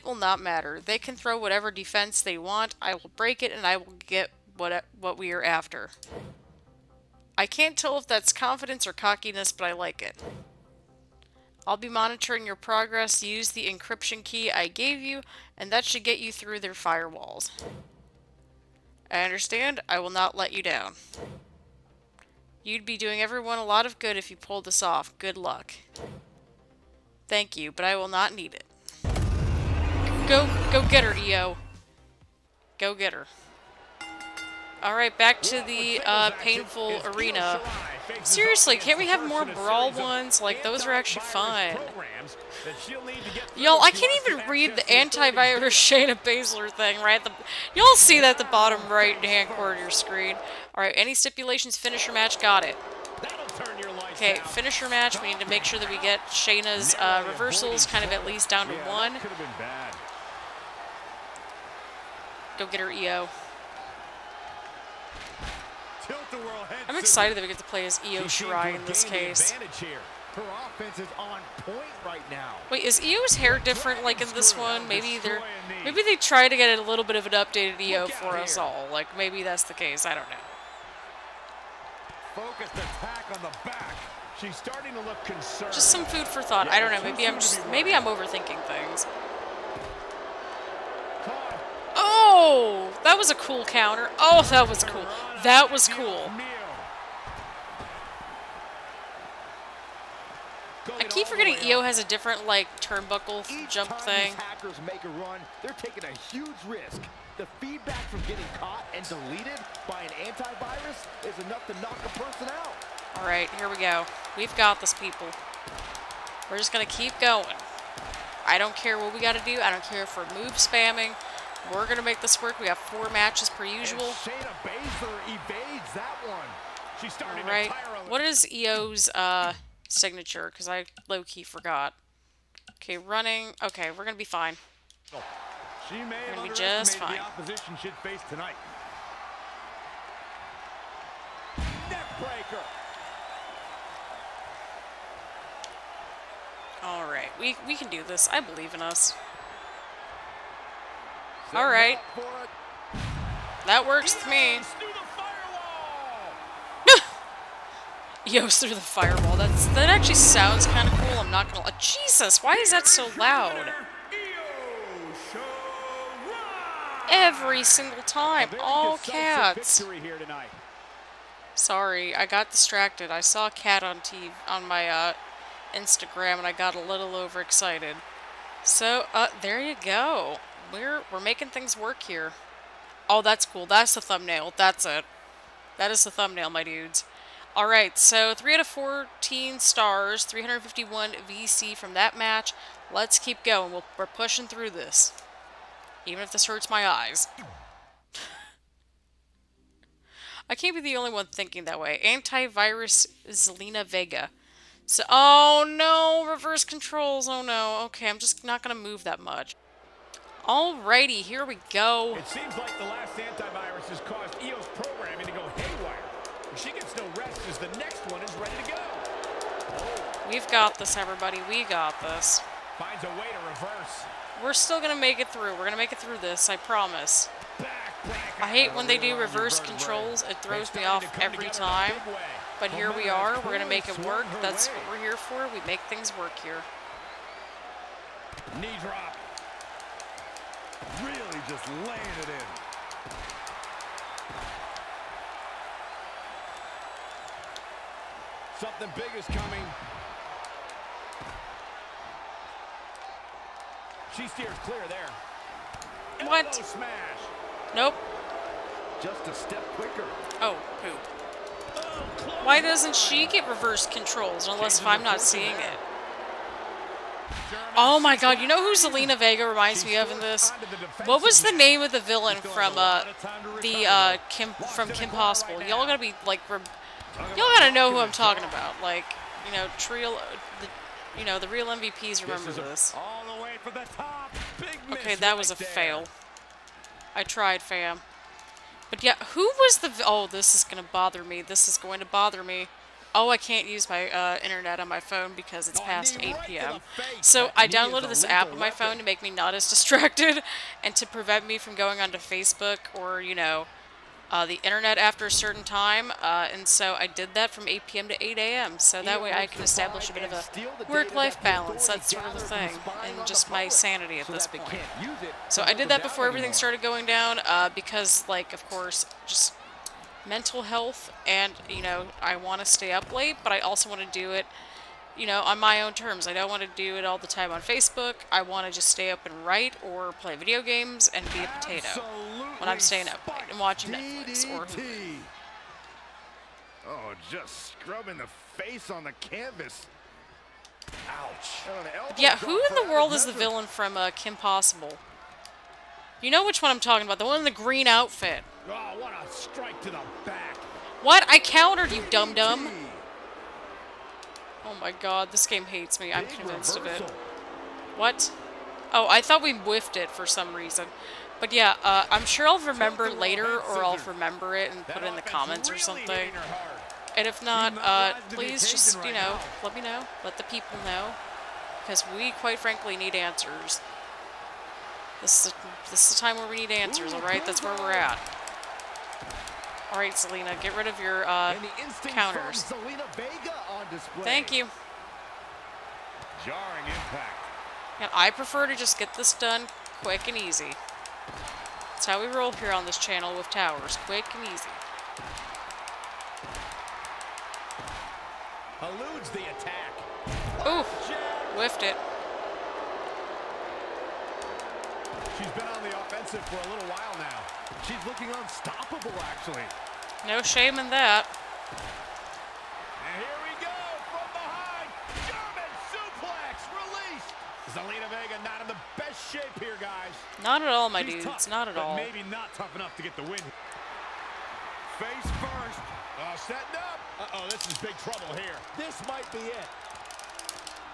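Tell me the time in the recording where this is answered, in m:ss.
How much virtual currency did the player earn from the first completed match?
3:10.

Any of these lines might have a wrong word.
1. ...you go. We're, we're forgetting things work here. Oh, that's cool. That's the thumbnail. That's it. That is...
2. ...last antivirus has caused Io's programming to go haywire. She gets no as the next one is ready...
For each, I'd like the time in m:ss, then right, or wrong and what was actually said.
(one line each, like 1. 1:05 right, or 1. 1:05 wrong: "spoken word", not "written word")
1. 2:59 wrong: "making", not "forgetting"
2. 3:32 right.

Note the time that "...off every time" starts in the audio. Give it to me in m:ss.
3:50.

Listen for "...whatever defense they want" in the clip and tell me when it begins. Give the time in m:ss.
0:01.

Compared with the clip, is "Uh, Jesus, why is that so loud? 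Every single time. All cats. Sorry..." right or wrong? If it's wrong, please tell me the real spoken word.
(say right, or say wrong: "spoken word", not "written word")
right.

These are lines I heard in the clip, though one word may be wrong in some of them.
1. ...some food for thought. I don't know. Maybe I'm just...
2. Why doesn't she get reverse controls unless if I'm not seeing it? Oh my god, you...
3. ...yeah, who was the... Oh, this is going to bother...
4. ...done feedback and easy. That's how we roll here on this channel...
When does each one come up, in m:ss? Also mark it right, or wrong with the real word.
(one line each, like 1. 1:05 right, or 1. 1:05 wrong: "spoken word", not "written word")
1. 1:25 right
2. 4:22 right
3. 4:49 right
4. 6:29 wrong: "quick", not "feedback".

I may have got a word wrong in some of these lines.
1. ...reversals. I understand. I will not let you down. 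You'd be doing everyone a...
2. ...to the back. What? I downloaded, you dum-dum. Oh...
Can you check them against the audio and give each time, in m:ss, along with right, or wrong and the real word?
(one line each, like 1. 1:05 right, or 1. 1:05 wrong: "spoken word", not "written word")
1. 0:16 wrong: "firewalls", not "reversals"
2. 5:49 wrong: "countered", not "downloaded".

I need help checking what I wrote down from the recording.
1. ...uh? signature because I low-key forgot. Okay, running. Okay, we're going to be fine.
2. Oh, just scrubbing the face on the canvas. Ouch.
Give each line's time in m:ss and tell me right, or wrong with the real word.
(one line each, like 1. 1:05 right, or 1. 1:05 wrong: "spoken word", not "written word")
1. 2:09 right
2. 5:36 right.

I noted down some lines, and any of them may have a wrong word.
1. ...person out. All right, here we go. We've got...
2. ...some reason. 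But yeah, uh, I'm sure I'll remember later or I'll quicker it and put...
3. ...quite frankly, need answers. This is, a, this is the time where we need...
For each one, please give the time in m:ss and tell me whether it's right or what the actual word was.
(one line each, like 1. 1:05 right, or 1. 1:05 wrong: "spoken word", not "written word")
1. 1:52 right
2. 6:00 wrong: "remember", not "quicker"
3. 6:12 right.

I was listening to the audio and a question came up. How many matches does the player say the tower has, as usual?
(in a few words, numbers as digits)
4.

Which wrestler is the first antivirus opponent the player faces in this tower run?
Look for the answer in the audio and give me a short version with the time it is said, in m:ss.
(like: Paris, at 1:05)
Shayna Baszler, at 0:45.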